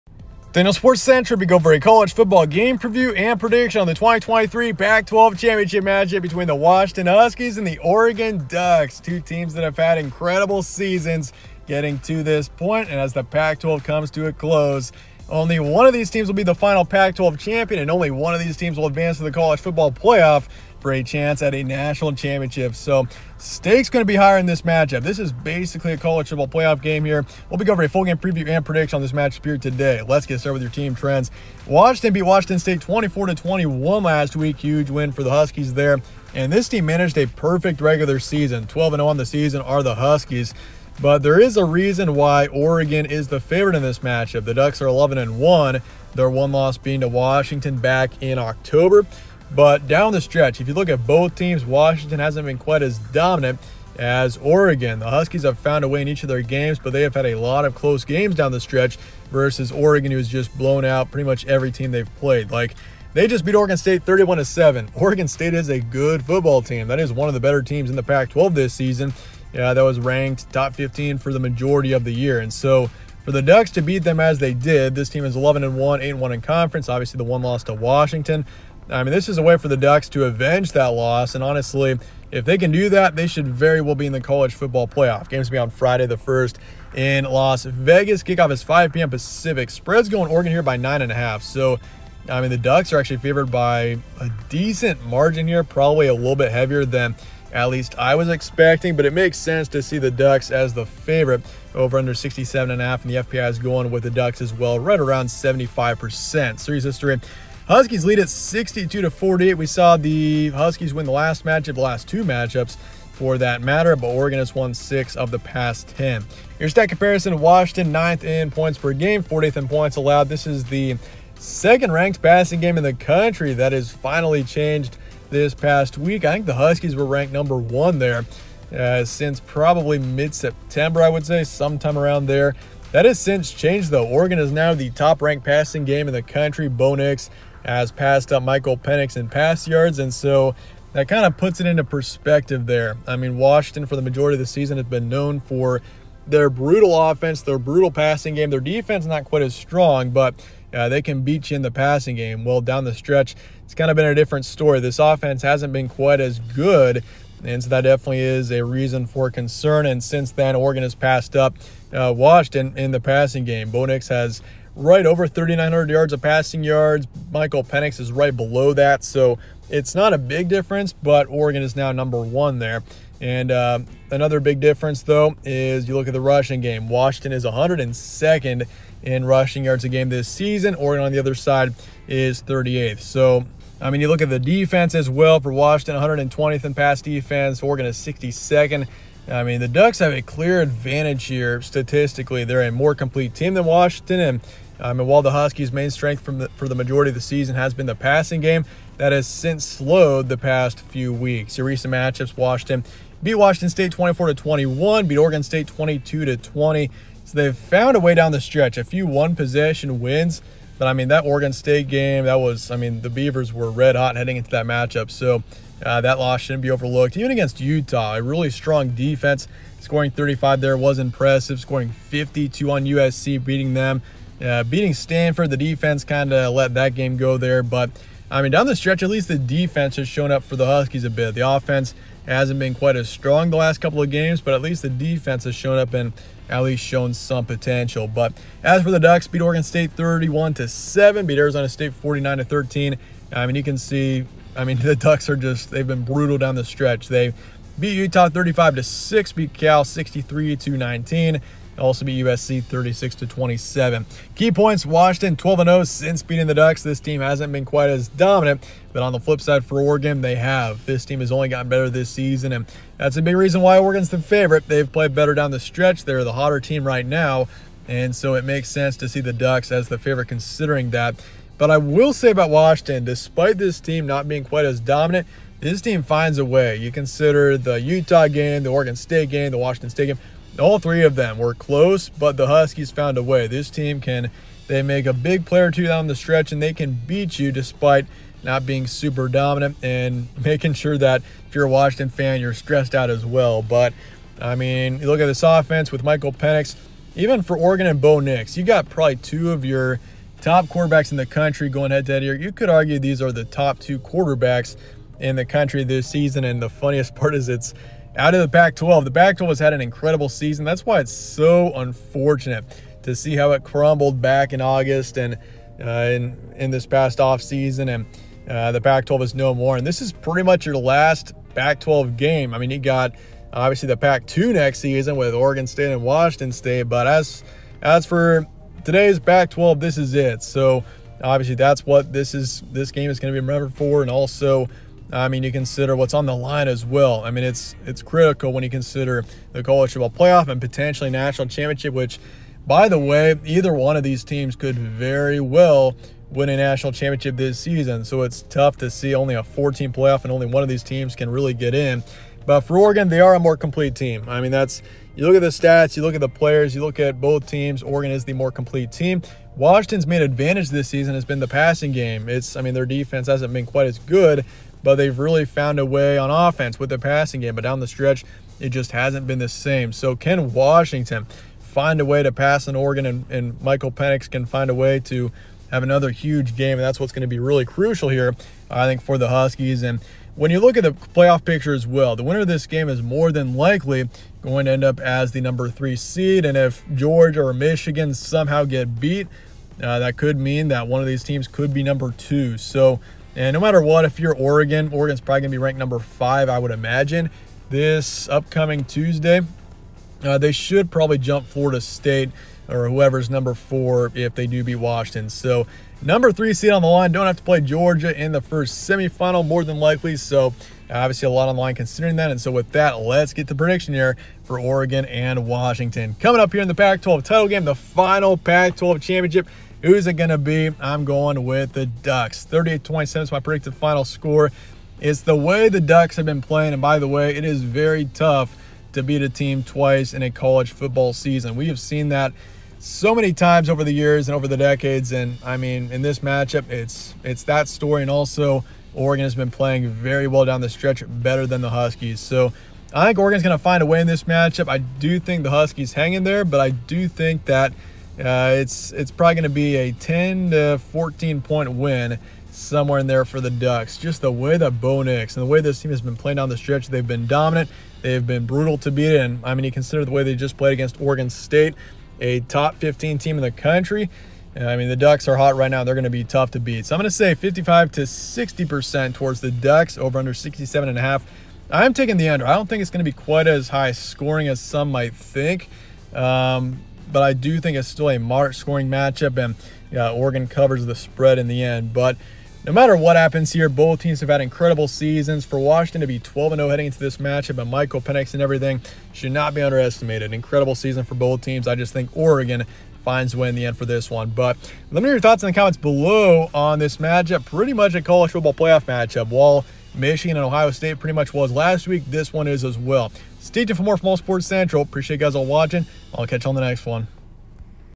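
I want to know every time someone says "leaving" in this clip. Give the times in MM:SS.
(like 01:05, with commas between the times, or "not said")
not said.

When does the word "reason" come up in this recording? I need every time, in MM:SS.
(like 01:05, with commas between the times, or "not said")
00:41, 02:38, 04:23.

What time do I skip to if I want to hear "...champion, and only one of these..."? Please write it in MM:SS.
00:17.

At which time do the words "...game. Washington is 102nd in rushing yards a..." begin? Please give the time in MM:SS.
02:56.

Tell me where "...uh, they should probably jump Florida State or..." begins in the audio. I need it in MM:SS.
06:40.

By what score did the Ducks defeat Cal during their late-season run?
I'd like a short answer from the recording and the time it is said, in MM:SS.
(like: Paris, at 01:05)
63 to 19, at 04:09.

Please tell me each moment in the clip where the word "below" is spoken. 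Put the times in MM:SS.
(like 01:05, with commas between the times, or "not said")
02:48, 08:15.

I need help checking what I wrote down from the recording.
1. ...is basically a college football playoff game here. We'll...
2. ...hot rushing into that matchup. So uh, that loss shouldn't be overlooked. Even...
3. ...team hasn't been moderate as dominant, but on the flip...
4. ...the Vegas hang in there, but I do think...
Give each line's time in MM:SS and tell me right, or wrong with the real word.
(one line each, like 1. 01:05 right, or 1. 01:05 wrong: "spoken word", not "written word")
1. 00:25 right
2. 03:33 wrong: "heading", not "rushing"
3. 04:16 wrong: "quite", not "moderate"
4. 07:25 wrong: "Huskies", not "Vegas".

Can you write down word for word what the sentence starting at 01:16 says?
Obviously, the one loss to Washington.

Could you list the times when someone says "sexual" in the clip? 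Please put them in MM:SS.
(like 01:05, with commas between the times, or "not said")
not said.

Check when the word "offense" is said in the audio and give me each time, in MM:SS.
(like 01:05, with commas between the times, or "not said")
02:27, 02:34, 03:51, 04:55, 06:06.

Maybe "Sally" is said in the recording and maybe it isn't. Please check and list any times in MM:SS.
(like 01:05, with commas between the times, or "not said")
not said.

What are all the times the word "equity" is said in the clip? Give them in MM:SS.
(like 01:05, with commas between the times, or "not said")
not said.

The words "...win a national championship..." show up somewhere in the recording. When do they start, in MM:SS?
05:46.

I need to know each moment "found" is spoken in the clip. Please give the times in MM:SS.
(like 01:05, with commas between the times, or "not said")
00:55, 03:27, 04:42, 06:05.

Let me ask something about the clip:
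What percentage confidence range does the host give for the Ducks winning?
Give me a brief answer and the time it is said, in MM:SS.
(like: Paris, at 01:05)
55 to 60%, at 07:47.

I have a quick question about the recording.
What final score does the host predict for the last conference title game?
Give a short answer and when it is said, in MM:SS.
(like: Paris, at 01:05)
38-27, at 07:02.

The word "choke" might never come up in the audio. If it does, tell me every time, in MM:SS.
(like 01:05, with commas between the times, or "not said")
not said.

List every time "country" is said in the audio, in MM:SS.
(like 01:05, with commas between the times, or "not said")
02:02, 02:16, 05:01, 05:05, 07:43.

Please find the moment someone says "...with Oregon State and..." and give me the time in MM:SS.
05:25.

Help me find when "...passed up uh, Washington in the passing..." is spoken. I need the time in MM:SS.
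02:40.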